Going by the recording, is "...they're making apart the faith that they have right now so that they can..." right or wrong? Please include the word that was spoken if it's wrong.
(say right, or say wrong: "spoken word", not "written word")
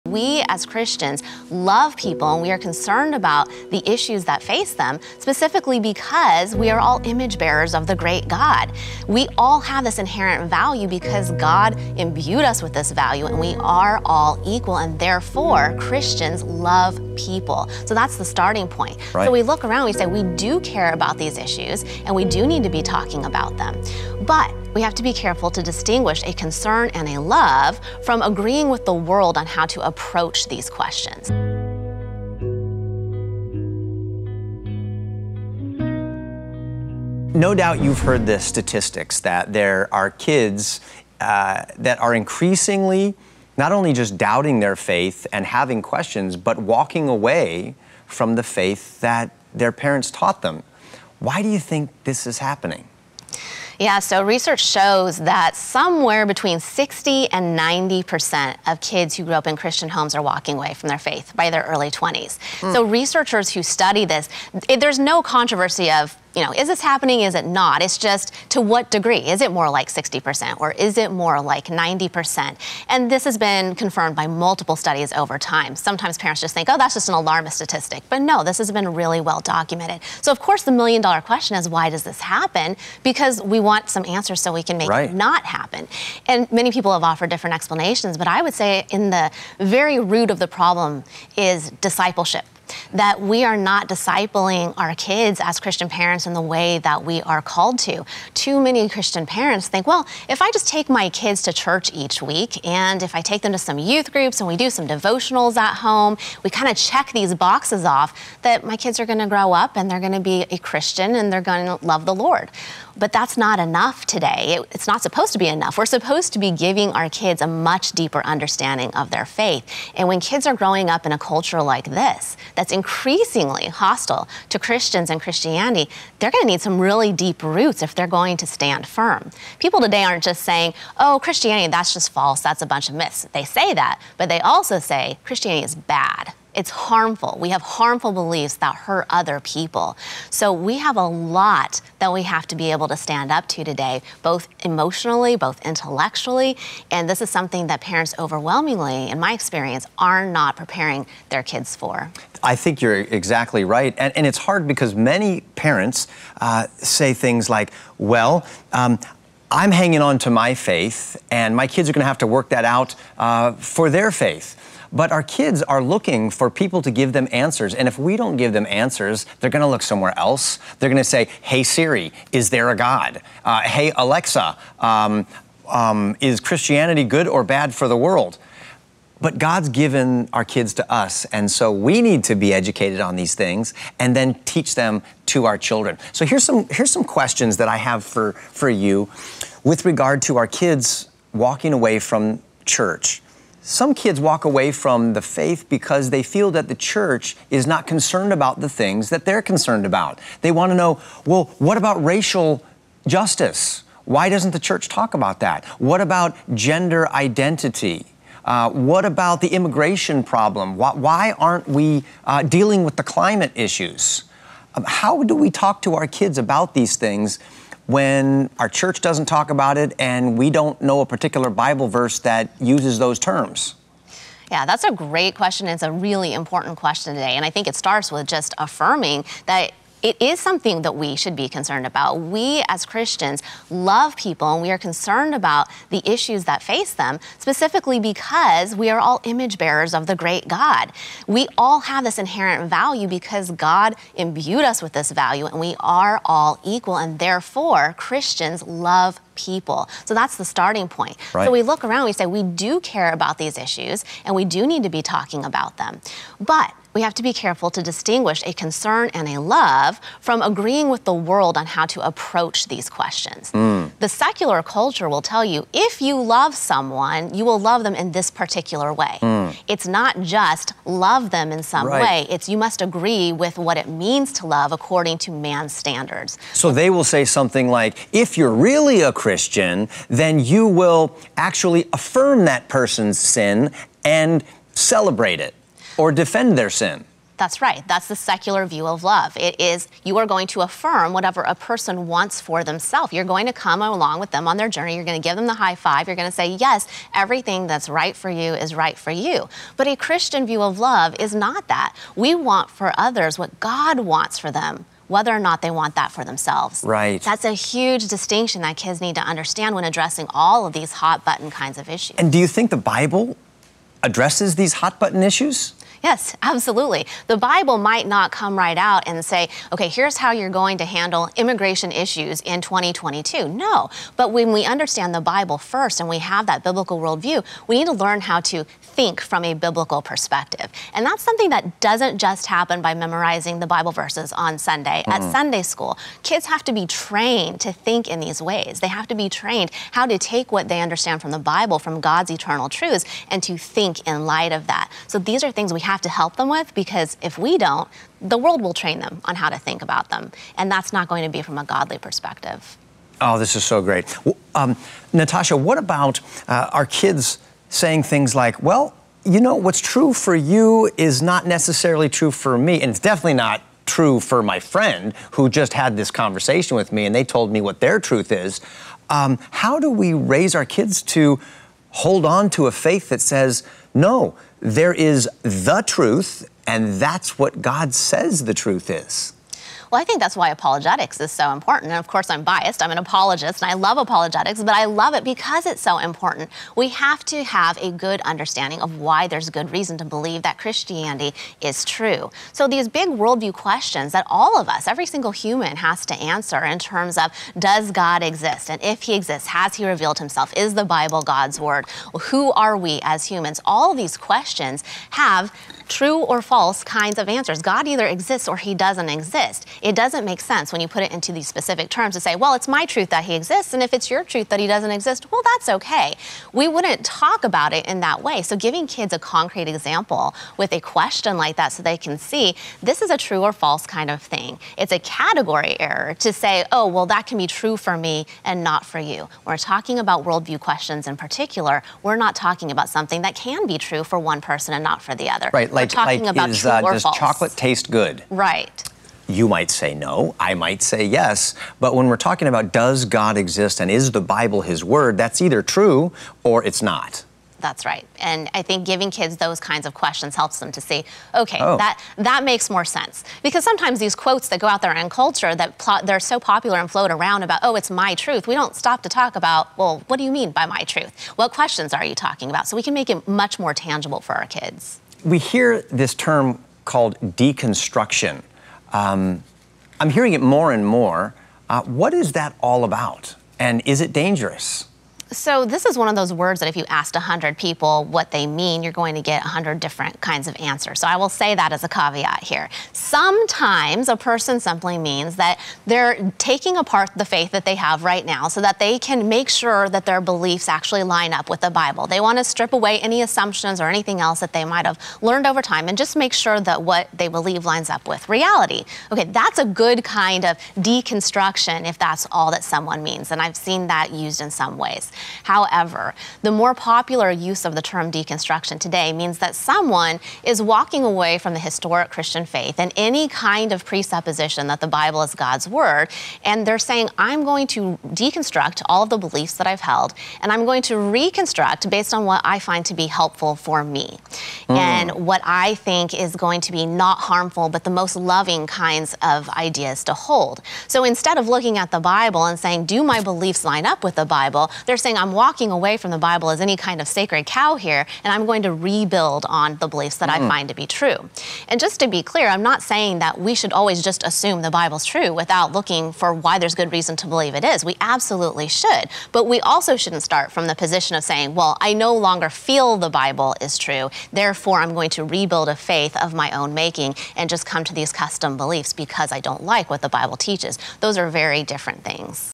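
wrong: "taking", not "making".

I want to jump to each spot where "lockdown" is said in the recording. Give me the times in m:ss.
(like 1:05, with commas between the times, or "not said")
not said.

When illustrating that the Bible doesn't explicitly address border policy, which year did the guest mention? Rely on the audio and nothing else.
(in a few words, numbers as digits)
2022.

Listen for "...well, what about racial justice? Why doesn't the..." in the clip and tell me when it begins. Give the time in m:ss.
3:21.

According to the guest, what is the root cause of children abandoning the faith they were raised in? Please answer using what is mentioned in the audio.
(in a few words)
Discipleship.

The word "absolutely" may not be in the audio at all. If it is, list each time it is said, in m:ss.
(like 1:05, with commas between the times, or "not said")
5:16, 9:07.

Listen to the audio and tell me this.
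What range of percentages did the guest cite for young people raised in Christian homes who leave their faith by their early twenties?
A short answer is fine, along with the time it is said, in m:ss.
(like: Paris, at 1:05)
60 to 90%, at 0:56.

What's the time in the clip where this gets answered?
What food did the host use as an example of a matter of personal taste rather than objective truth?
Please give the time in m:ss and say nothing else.
7:17.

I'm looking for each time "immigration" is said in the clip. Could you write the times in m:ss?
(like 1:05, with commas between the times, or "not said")
3:29, 5:21.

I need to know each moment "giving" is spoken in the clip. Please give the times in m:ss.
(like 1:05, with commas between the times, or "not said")
1:56, 6:58, 7:28.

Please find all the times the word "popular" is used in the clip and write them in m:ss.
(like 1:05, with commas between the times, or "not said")
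7:36, 8:26.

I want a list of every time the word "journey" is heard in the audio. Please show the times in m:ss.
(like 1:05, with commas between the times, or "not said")
4:54.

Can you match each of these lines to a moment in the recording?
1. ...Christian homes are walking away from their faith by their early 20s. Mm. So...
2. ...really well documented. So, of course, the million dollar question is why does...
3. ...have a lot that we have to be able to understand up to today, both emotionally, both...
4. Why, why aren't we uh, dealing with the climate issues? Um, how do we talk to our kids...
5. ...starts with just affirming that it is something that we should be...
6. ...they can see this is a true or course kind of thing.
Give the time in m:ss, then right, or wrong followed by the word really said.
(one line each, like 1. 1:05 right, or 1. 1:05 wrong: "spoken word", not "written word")
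1. 0:59 right
2. 1:18 right
3. 2:20 wrong: "stand", not "understand"
4. 3:30 right
5. 3:47 right
6. 7:01 wrong: "false", not "course".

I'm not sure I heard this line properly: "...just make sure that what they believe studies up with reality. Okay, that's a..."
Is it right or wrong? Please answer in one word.
wrong.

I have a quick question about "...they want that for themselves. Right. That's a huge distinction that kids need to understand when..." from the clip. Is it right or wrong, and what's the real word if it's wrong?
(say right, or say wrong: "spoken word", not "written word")
right.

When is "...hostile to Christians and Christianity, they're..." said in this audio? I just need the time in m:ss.
2:03.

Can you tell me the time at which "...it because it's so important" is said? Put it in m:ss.
6:25.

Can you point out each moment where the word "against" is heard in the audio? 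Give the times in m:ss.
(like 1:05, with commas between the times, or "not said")
not said.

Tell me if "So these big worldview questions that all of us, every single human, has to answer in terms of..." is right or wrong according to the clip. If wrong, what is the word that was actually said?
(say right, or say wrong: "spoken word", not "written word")
right.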